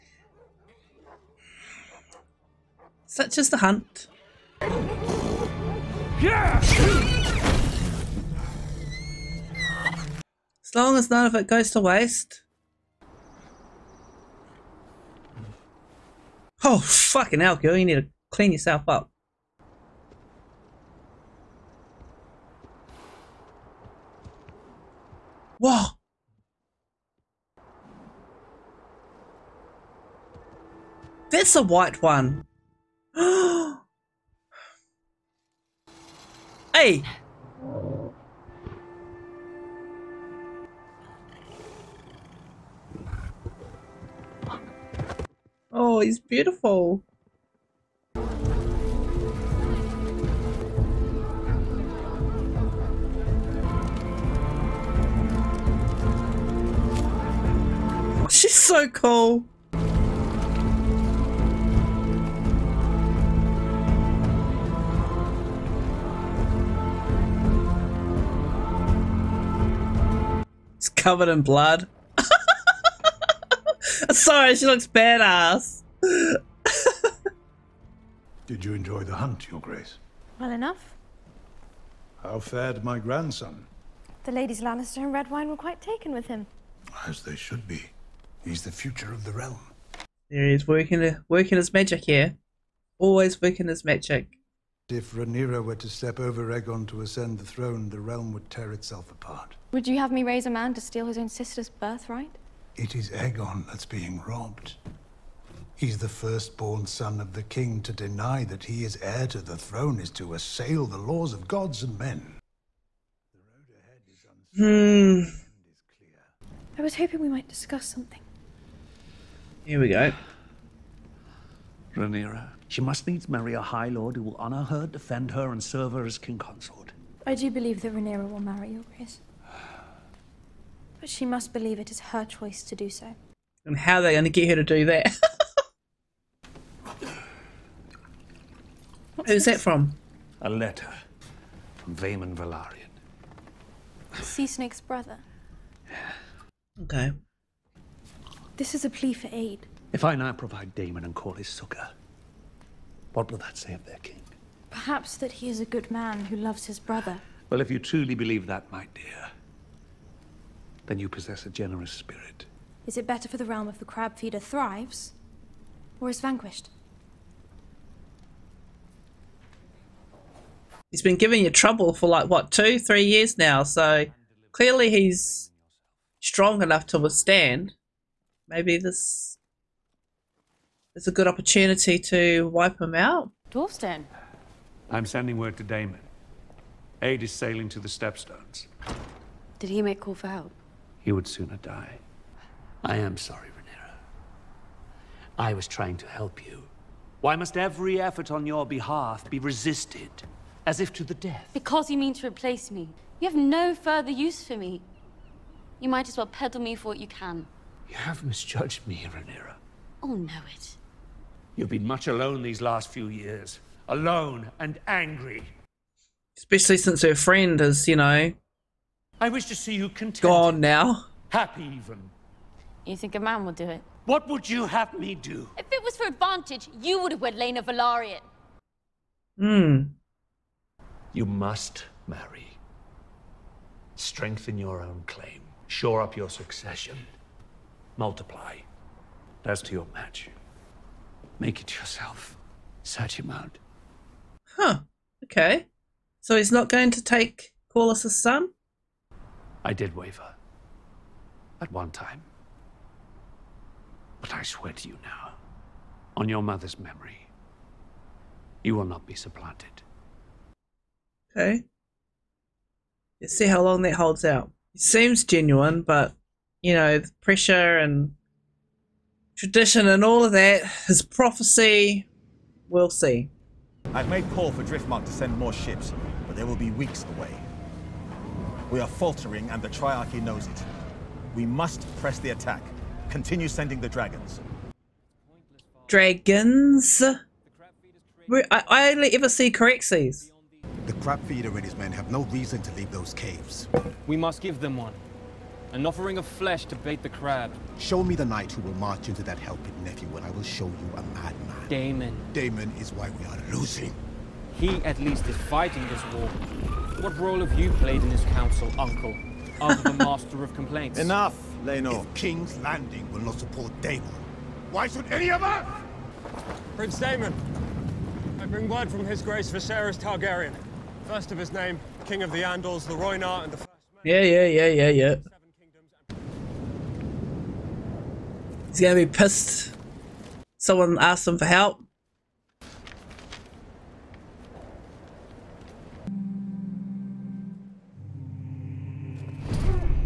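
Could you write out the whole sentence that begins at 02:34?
Perhaps that he is a good man who loves his brother.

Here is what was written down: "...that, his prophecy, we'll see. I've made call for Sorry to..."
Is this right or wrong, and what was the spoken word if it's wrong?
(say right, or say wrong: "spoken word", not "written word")
wrong: "Driftmark", not "Sorry".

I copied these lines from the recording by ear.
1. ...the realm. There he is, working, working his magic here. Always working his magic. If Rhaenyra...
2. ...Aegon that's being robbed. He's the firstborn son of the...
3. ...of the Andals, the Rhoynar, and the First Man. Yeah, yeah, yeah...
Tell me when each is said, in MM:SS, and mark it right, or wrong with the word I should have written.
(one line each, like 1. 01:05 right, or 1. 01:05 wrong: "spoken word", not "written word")
1. 01:29 right
2. 01:43 right
3. 05:22 right.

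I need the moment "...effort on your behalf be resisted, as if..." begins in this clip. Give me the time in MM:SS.
03:18.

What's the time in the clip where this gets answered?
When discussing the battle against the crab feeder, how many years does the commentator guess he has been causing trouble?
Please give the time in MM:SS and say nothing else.
02:52.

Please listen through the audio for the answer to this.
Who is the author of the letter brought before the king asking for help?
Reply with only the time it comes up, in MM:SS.
02:21.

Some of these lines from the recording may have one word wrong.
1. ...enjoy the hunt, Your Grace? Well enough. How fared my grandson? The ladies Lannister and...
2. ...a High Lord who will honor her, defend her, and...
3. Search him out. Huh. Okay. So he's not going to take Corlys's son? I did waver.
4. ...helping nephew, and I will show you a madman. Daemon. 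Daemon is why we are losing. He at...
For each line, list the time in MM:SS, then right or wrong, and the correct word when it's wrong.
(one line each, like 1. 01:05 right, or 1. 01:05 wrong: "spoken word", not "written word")
1. 01:18 right
2. 02:03 right
3. 04:02 right
4. 04:59 right.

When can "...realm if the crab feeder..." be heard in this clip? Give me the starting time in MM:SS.
02:43.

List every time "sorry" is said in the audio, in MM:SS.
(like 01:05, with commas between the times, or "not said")
01:14, 03:13.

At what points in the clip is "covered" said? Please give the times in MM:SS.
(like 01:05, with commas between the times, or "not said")
01:11.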